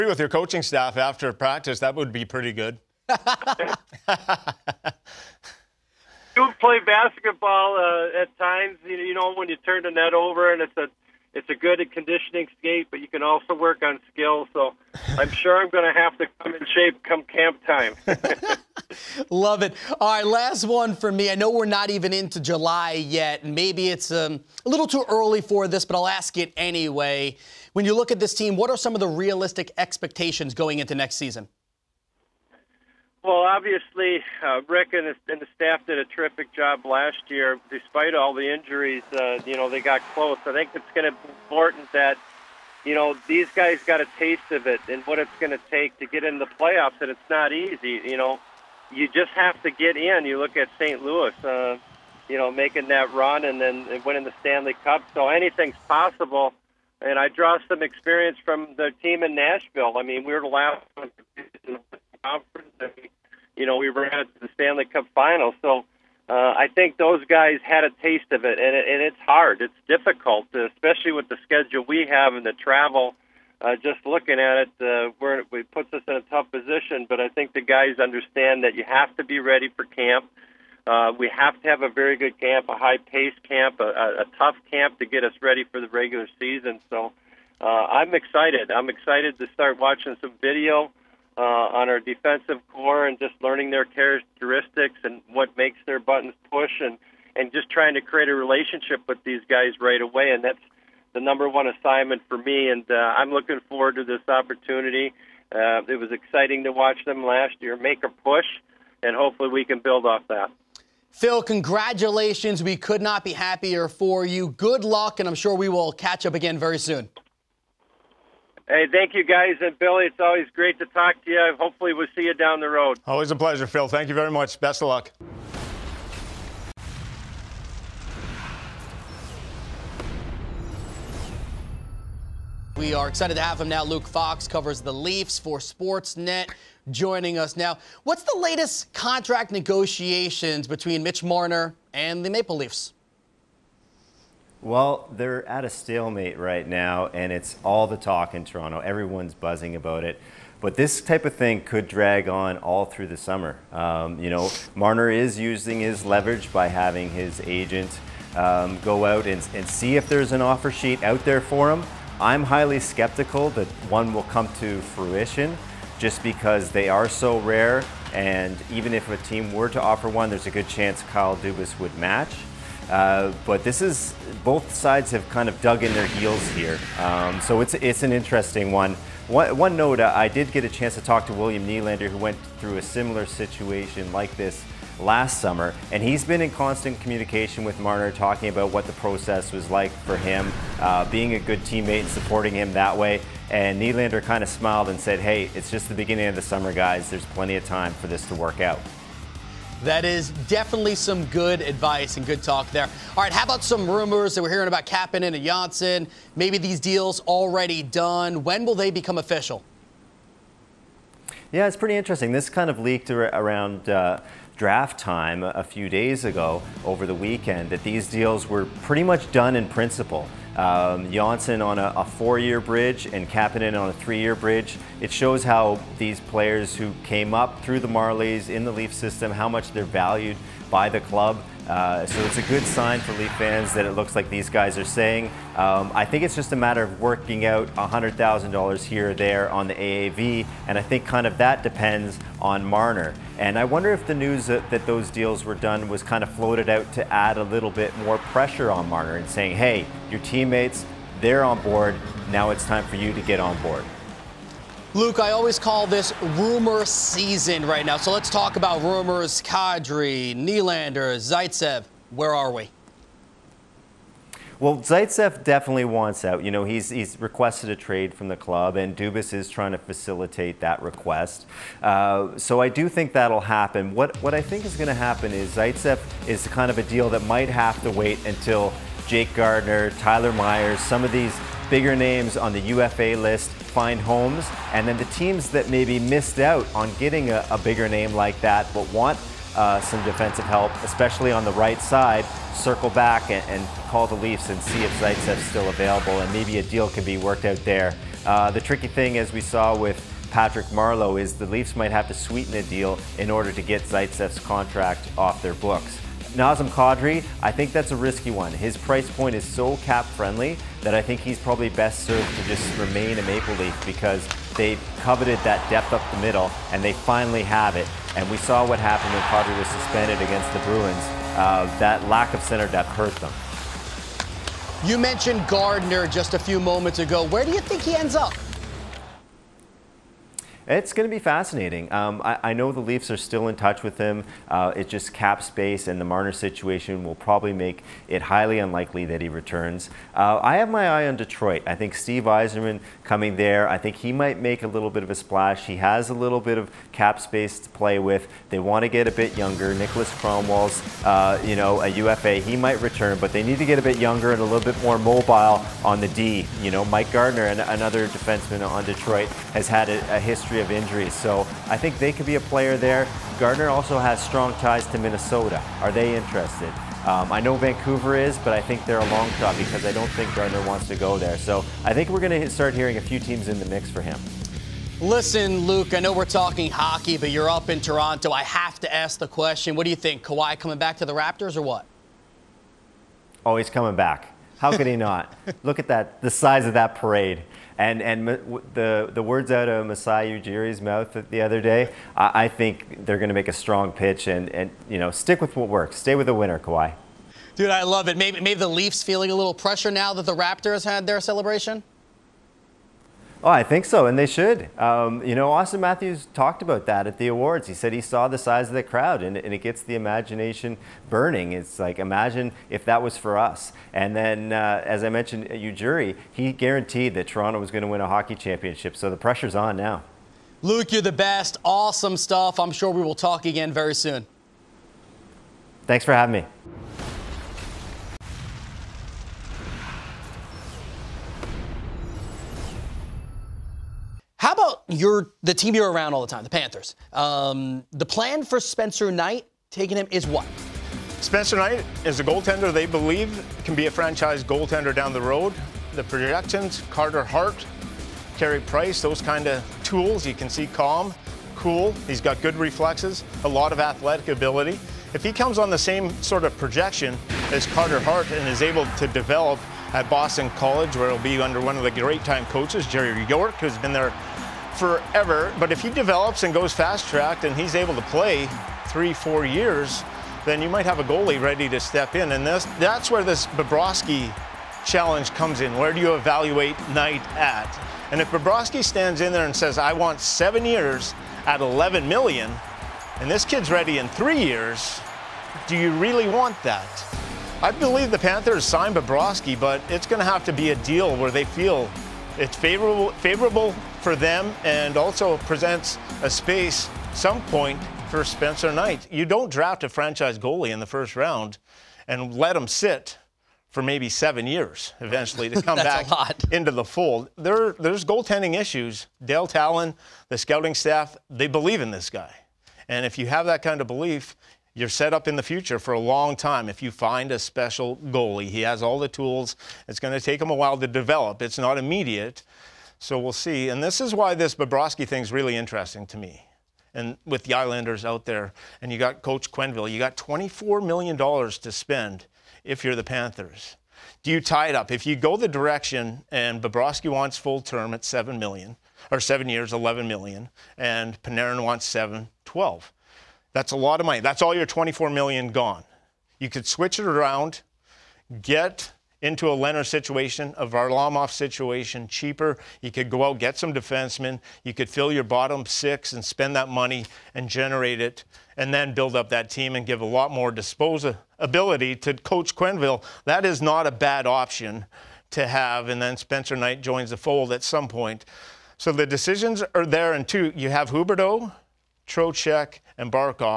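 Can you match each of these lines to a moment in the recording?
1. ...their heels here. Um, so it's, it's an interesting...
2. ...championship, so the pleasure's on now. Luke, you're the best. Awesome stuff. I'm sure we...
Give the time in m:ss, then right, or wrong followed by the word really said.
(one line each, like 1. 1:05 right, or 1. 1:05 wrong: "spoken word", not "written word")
1. 2:55 right
2. 6:58 wrong: "pressure", not "pleasure".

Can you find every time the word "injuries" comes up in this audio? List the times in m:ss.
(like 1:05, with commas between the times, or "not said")
0:38, 6:00.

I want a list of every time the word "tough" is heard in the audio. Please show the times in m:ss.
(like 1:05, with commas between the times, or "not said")
1:16, 1:24.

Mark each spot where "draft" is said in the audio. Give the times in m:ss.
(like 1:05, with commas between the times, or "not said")
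3:34, 8:19.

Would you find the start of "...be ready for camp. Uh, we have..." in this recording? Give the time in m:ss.
1:19.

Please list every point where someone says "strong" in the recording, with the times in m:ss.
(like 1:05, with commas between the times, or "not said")
6:04, 6:33.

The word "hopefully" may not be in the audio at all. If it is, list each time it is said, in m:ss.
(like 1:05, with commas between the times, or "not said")
1:49, 2:01.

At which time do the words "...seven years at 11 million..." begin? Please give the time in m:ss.
8:00.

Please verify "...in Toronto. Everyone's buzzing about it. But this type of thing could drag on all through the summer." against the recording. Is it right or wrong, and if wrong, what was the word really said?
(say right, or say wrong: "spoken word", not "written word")
right.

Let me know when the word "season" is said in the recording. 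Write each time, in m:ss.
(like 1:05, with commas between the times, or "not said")
0:31, 1:26, 4:16.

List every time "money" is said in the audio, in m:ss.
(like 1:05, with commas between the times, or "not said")
9:04, 9:16.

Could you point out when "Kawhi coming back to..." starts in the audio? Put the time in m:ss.
6:20.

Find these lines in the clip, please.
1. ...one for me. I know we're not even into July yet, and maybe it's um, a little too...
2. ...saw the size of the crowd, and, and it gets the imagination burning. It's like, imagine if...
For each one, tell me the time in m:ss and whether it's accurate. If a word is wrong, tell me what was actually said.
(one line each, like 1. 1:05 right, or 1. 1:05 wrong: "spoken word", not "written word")
1. 0:20 right
2. 6:47 right.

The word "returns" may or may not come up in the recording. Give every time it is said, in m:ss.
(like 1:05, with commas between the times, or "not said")
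5:39, 5:52.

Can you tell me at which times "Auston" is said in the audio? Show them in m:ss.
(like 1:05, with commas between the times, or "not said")
6:45.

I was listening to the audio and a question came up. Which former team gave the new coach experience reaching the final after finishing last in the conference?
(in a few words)
Nashville.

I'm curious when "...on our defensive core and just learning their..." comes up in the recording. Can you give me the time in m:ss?
1:31.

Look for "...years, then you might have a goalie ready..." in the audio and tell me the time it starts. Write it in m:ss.
7:49.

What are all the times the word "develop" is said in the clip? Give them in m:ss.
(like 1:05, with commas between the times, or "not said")
7:39, 7:45, 8:40.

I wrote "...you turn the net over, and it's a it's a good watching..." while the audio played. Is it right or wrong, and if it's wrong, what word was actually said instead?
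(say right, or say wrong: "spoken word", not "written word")
wrong: "conditioning", not "watching".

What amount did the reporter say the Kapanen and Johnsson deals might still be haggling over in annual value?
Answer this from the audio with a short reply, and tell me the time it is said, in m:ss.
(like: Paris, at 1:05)
$100,000, at 3:57.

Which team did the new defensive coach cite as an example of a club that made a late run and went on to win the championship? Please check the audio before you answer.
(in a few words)
St. Louis.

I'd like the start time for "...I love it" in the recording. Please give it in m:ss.
6:37.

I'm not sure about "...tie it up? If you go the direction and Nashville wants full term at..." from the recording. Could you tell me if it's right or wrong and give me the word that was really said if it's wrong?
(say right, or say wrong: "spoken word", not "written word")
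wrong: "Bobrovsky", not "Nashville".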